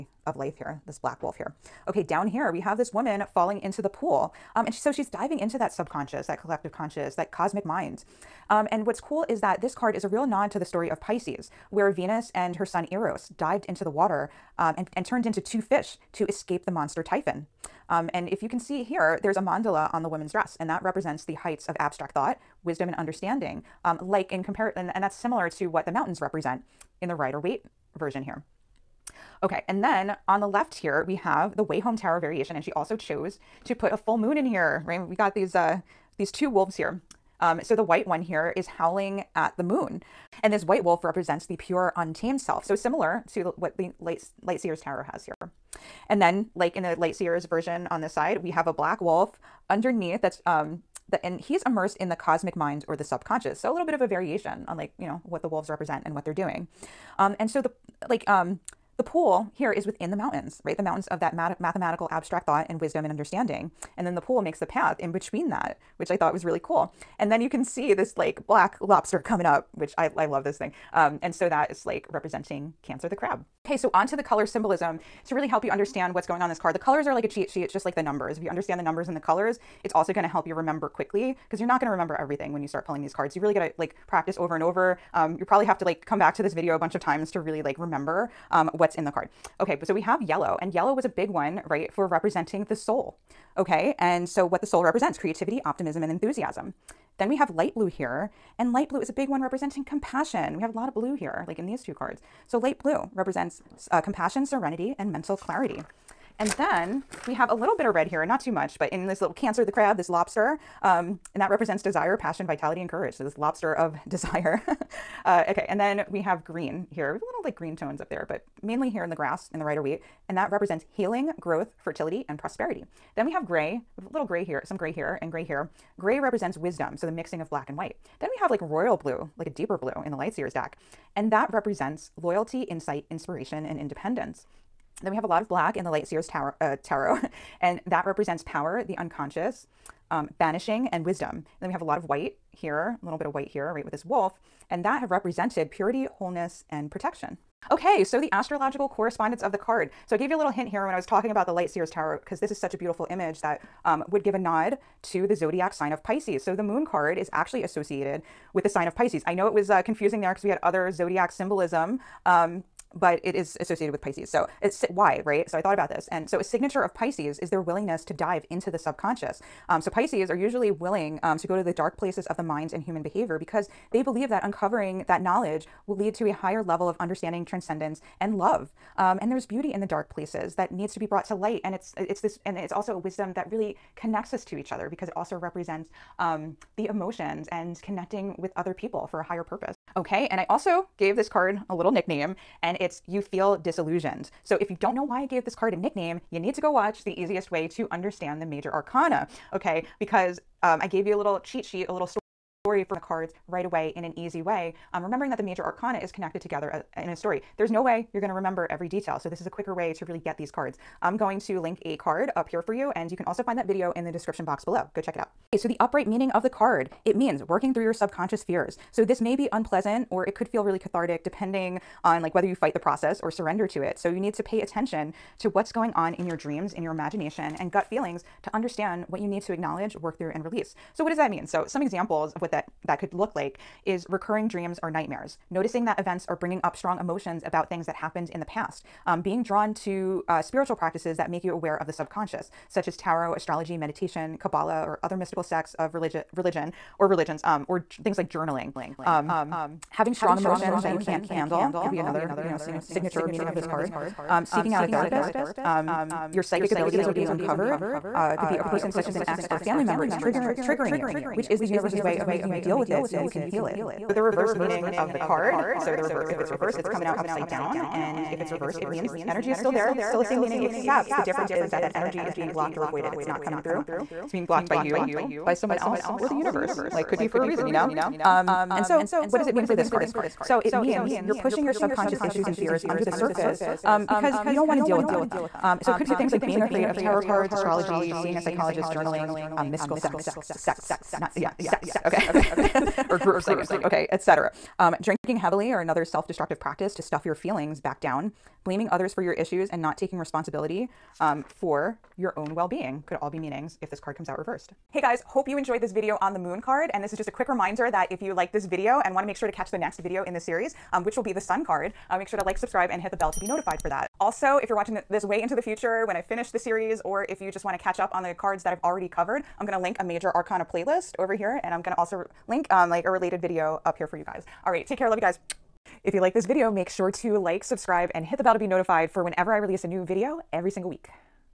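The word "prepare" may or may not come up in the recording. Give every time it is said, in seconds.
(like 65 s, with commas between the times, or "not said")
not said.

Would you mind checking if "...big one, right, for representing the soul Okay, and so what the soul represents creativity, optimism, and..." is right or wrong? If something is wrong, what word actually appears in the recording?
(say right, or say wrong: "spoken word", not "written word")
right.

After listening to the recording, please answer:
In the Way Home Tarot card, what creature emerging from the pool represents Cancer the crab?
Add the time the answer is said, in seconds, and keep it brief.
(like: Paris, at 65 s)
black lobster, at 68 s.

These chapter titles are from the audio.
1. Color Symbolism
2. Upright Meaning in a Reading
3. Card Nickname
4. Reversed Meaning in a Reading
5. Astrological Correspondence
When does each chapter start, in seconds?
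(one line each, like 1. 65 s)
1. 73 s
2. 215 s
3. 189 s
4. 263 s
5. 147 s.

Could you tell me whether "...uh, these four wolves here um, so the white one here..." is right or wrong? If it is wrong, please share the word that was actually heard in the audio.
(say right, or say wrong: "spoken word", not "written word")
wrong: "two", not "four".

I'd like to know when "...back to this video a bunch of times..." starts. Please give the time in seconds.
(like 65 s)
86 s.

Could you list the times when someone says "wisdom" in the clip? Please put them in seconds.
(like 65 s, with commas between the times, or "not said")
22 s, 62 s, 126 s, 141 s, 182 s.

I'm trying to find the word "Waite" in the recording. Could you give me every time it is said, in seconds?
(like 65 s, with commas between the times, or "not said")
27 s, 119 s.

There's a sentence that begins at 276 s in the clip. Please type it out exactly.
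Like, could be for a reason, you know?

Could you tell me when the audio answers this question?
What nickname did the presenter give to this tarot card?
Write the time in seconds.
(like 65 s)
193 s.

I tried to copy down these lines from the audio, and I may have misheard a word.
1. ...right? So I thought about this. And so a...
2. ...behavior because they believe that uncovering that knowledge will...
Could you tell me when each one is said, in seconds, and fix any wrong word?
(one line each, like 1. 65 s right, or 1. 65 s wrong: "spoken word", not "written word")
1. 165 s right
2. 173 s right.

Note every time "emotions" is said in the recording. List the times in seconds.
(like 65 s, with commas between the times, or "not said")
186 s, 236 s, 250 s.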